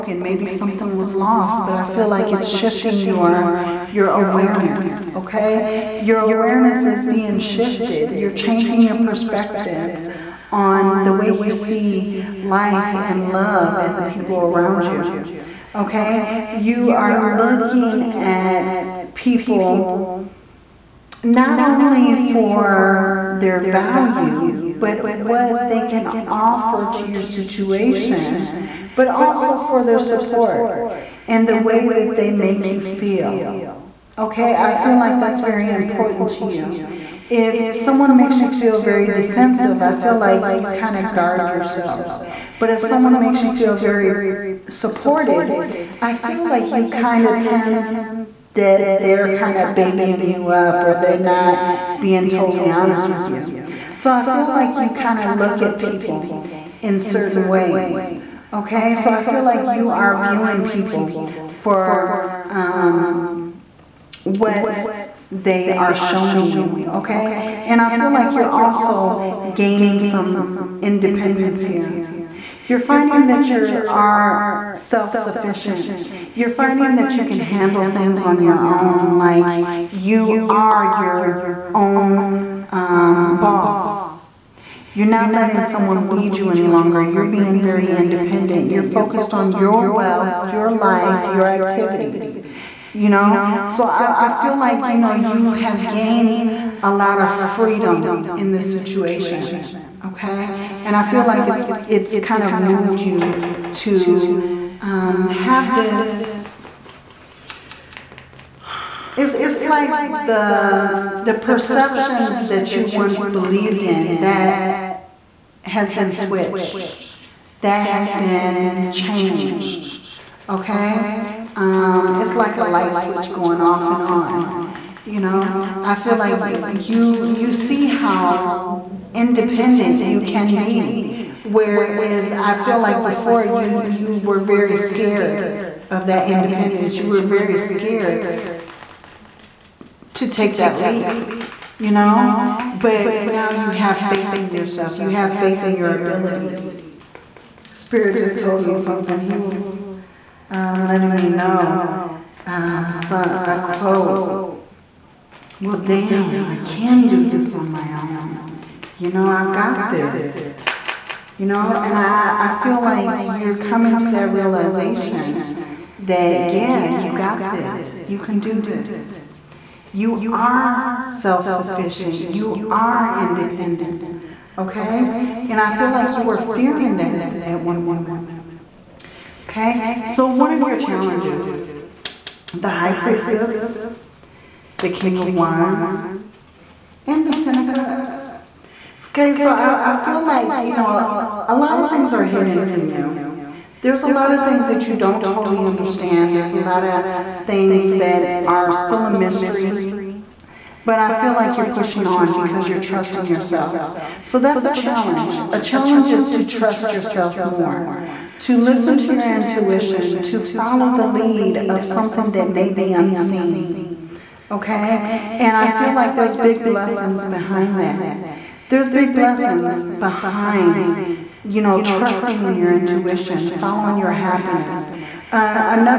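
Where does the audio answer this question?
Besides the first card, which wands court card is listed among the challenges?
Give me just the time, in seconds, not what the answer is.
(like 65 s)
184 s.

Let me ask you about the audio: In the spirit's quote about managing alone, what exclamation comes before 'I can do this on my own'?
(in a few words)
Well, damn.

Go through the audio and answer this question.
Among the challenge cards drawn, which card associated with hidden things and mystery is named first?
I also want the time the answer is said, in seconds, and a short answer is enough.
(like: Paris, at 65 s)
The High Priestess, at 182 s.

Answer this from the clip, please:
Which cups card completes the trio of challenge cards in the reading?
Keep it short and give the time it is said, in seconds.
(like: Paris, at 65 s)
Ten of Cups, at 187 s.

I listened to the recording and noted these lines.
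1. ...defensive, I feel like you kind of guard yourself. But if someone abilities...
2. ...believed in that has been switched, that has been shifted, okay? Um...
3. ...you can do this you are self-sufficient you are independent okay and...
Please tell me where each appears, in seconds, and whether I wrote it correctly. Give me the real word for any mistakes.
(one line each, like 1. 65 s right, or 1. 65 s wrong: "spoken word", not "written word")
1. 39 s wrong: "makes", not "abilities"
2. 113 s wrong: "changed", not "shifted"
3. 168 s right.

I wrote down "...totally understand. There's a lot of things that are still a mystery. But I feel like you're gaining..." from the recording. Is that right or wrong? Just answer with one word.
wrong.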